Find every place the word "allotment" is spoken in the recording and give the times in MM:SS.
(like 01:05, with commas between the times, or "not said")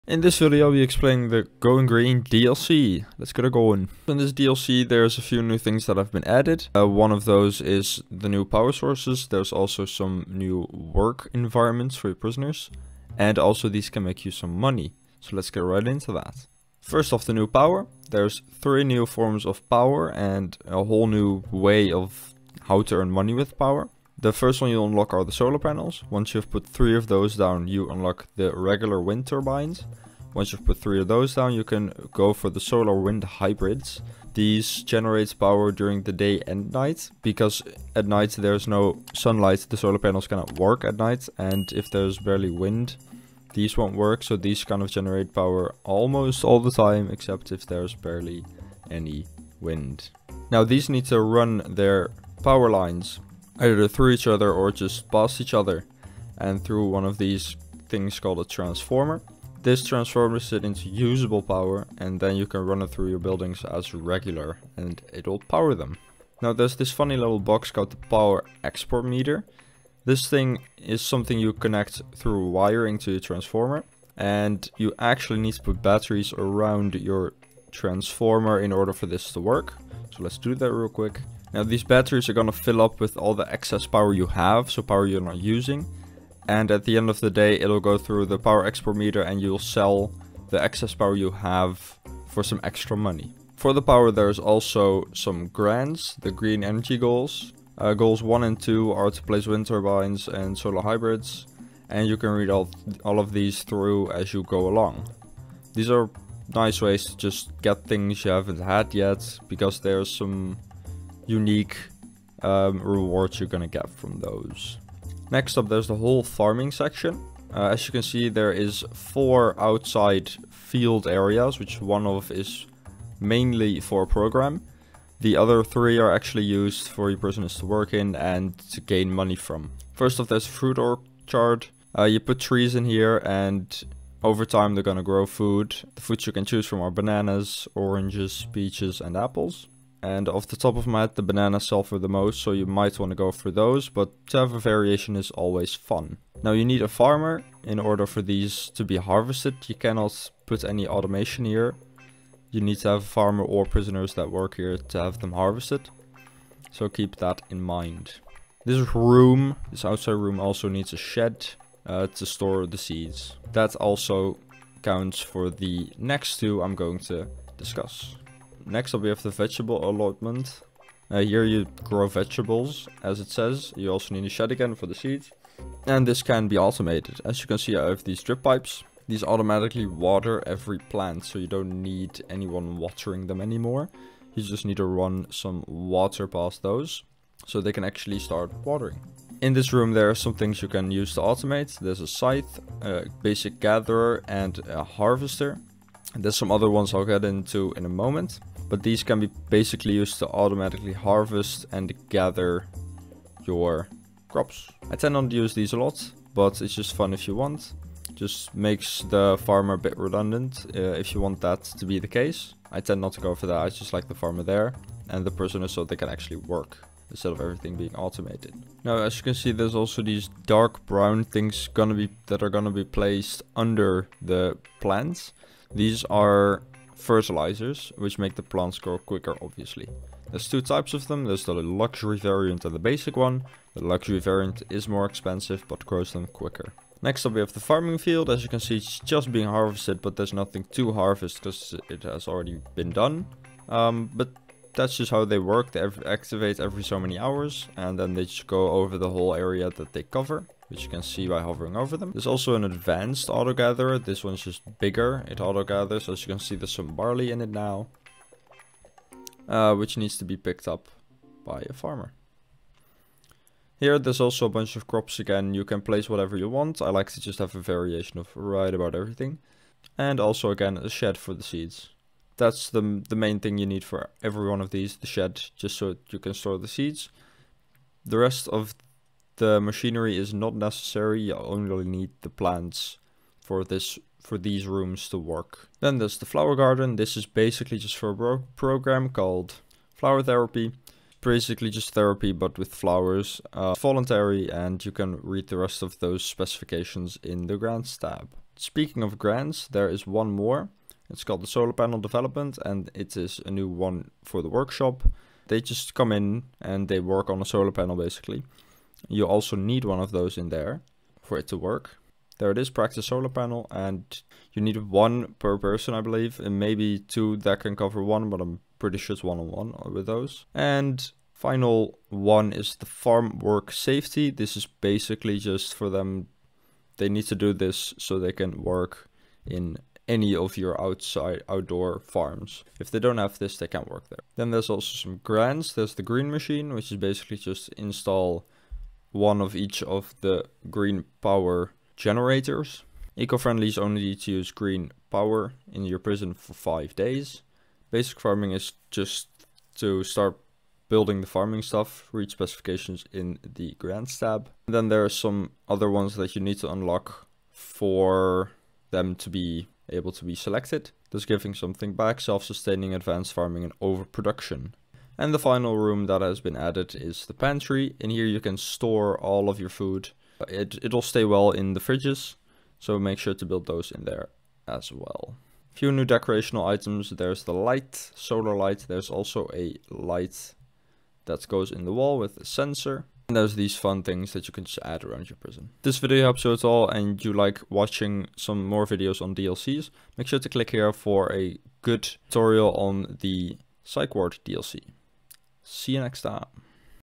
02:49.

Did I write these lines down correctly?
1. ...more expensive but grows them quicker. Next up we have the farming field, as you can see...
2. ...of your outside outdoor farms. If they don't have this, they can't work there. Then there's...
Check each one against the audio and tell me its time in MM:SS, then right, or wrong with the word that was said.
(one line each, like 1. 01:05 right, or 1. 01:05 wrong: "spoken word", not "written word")
1. 03:54 right
2. 05:30 right.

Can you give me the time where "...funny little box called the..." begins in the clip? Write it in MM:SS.
01:06.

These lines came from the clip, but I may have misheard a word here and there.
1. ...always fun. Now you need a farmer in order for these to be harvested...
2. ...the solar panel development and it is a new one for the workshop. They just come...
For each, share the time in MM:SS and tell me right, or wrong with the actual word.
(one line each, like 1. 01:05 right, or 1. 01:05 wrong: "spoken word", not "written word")
1. 02:25 right
2. 05:01 right.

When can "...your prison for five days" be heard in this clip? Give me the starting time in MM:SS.
05:45.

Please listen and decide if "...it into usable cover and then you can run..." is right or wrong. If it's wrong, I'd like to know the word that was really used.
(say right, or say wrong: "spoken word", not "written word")
wrong: "power", not "cover".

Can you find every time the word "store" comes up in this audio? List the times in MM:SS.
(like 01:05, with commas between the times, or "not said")
02:42, 04:36, 06:08.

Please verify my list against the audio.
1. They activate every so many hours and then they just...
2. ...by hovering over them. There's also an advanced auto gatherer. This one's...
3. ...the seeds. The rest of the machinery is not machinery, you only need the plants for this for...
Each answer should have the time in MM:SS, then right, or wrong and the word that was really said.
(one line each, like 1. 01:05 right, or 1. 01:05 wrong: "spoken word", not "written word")
1. 04:05 right
2. 04:11 right
3. 04:36 wrong: "necessary", not "machinery".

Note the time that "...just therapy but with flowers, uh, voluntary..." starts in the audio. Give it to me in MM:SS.
04:51.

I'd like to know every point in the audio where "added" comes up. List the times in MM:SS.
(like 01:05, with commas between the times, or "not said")
00:06, 06:06.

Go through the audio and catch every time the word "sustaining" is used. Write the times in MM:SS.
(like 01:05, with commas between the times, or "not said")
06:02.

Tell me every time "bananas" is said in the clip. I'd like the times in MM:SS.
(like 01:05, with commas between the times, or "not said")
02:16, 02:21.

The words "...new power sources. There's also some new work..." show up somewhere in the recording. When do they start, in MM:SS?
00:08.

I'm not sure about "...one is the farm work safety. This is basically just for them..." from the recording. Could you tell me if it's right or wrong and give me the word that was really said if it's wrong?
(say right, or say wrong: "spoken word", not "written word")
right.